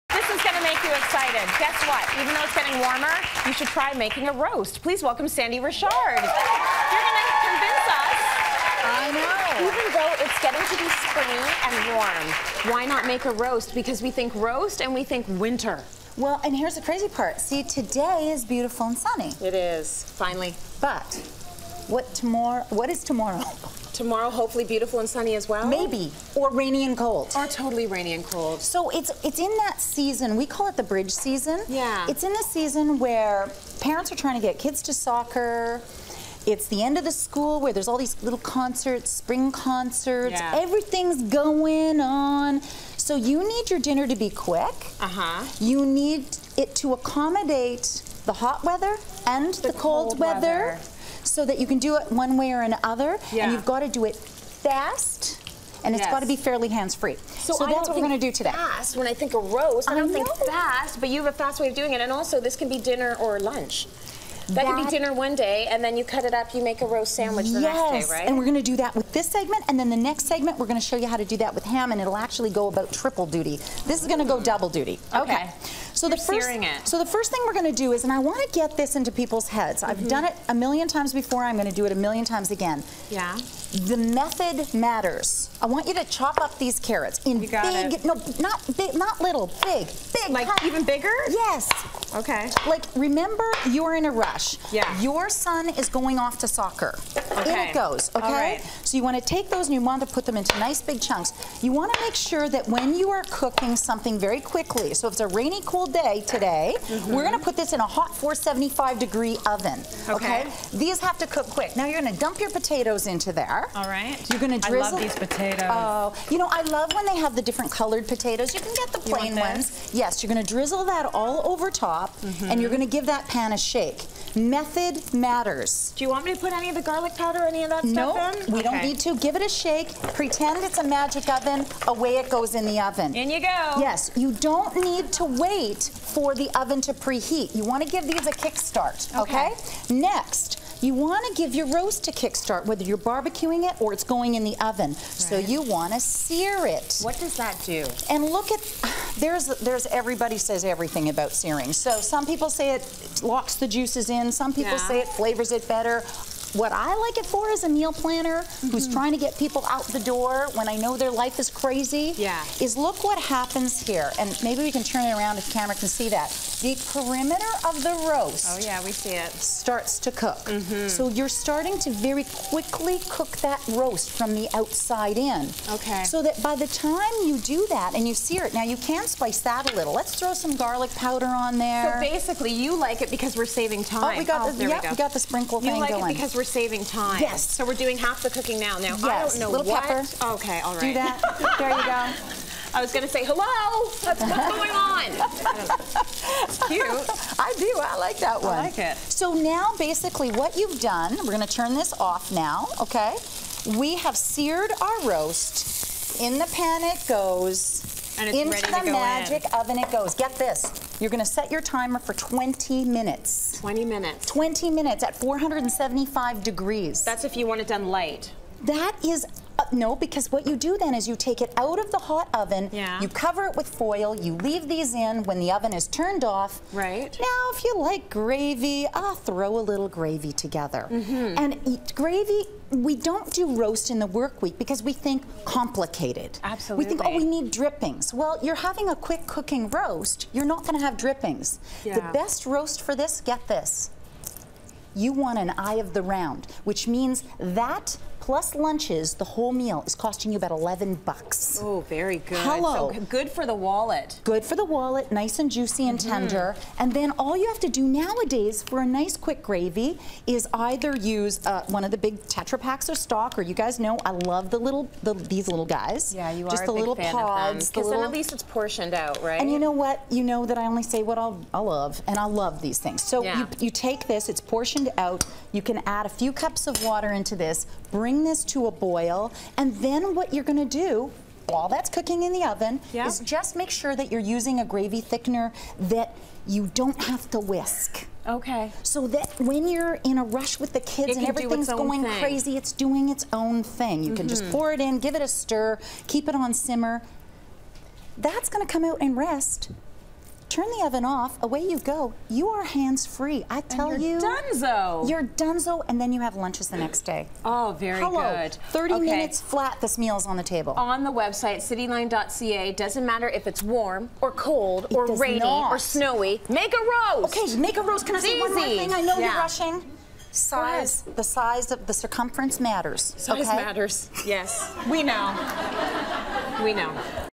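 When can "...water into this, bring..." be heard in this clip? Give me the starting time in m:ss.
4:36.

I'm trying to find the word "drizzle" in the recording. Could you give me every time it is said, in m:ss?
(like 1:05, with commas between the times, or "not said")
1:54, 2:00.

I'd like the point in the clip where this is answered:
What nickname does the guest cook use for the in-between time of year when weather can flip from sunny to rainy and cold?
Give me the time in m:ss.
0:30.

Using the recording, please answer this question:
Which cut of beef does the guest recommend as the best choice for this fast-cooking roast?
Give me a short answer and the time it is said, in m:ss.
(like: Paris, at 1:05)
eye of the round, at 4:05.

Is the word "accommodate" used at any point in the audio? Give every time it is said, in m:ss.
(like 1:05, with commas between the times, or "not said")
0:46.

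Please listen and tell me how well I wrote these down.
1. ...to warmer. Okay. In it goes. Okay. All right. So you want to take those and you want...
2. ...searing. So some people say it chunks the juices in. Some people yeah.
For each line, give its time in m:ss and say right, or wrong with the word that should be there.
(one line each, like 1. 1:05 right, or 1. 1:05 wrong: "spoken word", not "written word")
1. 1:36 wrong: "soccer", not "warmer"
2. 2:31 wrong: "locks", not "chunks".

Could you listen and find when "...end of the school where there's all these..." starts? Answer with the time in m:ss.
0:36.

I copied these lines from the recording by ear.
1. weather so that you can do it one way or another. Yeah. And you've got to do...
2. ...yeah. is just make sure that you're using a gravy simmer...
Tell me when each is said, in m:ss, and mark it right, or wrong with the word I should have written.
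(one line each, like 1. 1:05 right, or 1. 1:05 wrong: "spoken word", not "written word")
1. 0:50 right
2. 4:42 wrong: "thickener", not "simmer".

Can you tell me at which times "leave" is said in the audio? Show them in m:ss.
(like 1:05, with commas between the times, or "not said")
3:44.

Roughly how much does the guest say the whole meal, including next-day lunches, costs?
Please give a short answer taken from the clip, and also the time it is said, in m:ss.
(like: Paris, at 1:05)
$11, at 4:10.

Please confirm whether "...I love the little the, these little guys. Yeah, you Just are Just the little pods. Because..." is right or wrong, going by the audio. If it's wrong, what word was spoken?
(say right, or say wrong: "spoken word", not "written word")
right.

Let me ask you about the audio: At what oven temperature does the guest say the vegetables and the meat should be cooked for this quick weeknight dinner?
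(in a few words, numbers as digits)
475 degrees.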